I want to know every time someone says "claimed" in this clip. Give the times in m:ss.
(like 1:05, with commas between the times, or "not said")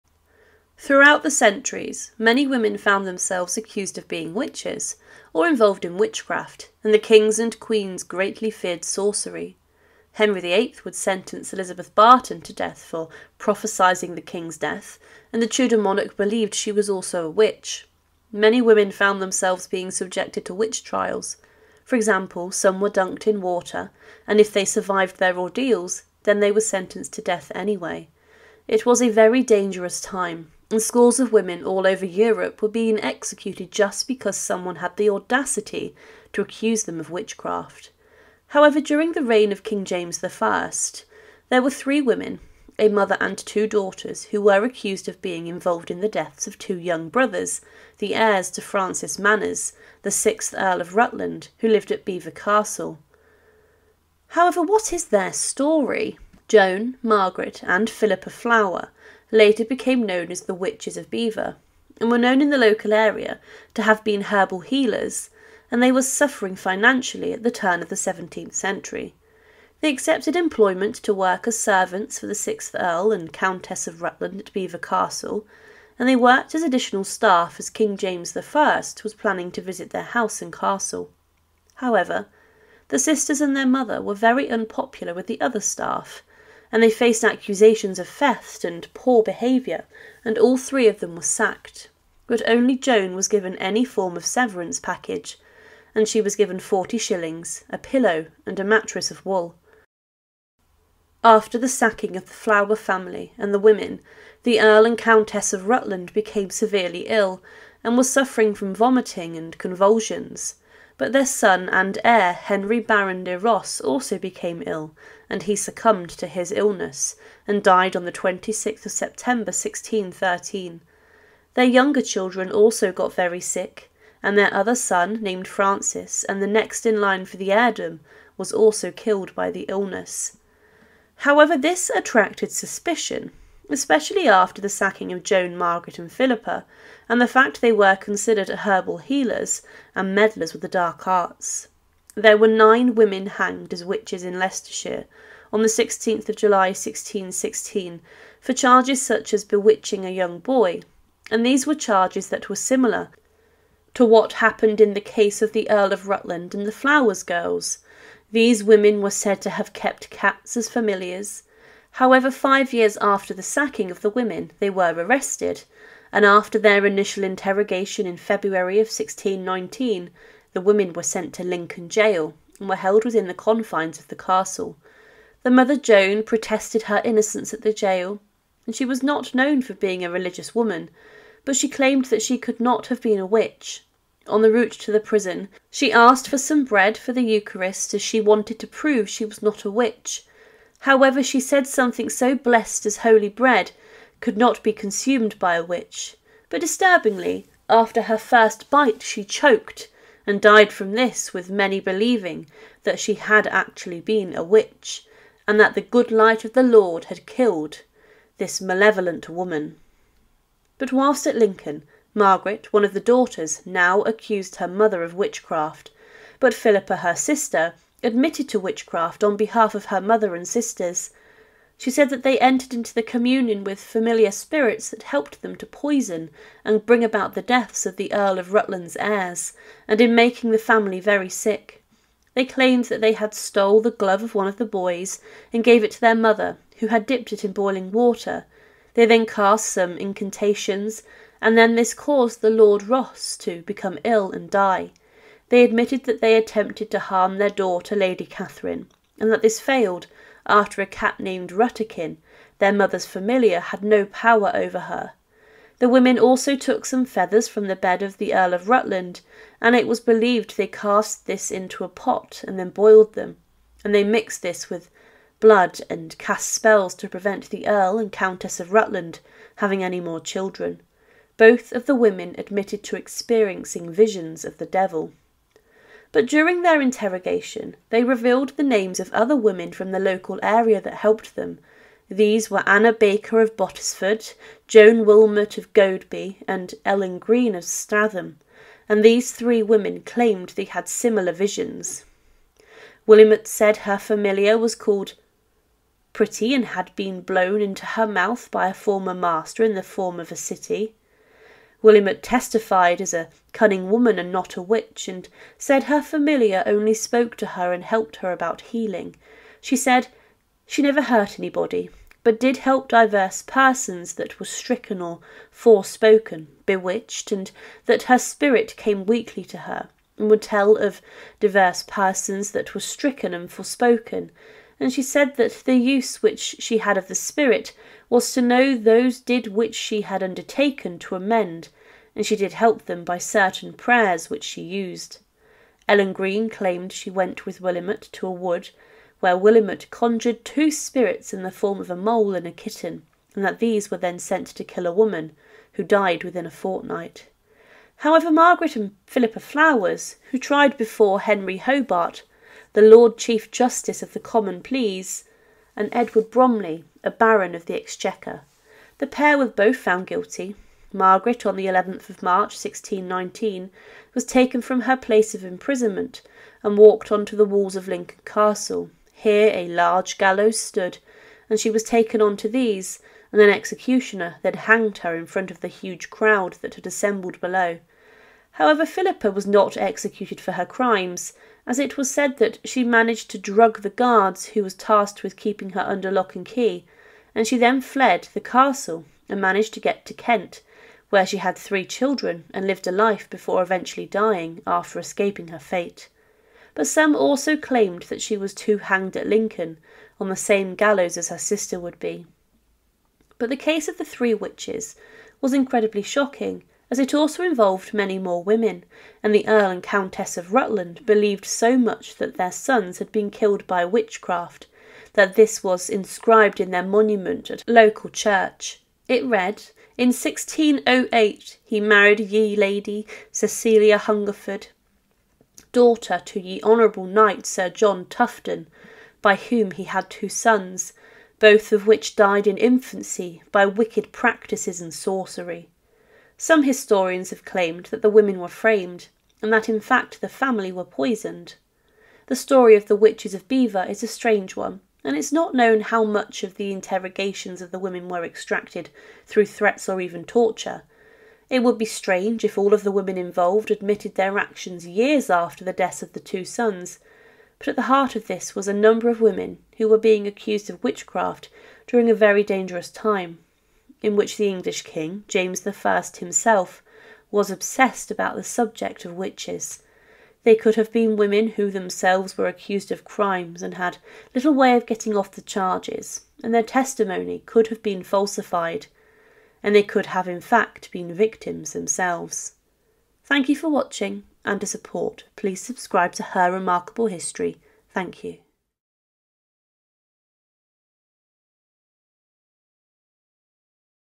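3:01, 3:52, 4:50, 5:36, 6:37, 7:17.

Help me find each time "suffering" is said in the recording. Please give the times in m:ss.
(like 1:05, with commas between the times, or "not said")
1:06, 1:48.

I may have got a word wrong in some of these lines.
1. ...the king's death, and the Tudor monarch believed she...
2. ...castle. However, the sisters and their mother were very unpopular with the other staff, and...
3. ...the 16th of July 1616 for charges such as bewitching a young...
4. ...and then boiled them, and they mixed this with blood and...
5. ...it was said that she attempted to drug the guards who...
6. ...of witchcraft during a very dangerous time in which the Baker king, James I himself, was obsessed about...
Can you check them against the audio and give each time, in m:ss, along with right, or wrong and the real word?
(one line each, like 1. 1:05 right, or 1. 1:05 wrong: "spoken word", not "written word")
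1. 0:14 right
2. 1:20 right
3. 2:25 right
4. 4:22 right
5. 6:21 wrong: "managed", not "attempted"
6. 7:40 wrong: "English", not "Baker".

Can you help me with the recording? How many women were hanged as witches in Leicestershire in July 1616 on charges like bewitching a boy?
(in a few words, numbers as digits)
9.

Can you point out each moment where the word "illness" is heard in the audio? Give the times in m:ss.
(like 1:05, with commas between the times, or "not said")
1:56, 2:09.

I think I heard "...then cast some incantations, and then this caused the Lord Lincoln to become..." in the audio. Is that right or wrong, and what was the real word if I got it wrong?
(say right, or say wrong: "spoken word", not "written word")
wrong: "Ross", not "Lincoln".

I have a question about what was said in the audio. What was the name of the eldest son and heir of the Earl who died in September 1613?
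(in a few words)
Henry Baron de Ross.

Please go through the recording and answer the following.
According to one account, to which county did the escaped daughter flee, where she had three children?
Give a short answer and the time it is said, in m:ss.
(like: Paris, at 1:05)
Kent, at 6:30.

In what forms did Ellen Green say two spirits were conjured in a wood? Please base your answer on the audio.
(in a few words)
a mole and a kitten.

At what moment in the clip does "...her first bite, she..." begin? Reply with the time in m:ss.
3:18.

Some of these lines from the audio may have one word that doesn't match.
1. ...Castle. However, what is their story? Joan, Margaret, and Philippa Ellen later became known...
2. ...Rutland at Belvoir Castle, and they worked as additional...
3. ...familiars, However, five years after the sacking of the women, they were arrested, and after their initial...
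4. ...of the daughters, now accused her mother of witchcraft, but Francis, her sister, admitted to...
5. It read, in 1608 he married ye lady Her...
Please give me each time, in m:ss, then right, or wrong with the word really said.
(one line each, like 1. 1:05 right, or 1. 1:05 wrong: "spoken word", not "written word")
1. 0:52 wrong: "Flower", not "Ellen"
2. 1:14 right
3. 2:40 right
4. 3:32 wrong: "Philippa", not "Francis"
5. 6:59 wrong: "Cecilia", not "Her".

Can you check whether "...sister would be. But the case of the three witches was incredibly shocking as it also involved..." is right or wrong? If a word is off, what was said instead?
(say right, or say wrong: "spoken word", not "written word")
right.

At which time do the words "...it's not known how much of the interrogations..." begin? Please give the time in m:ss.
7:25.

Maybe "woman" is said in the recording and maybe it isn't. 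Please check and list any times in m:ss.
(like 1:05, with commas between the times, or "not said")
3:00, 3:29, 5:03, 5:44.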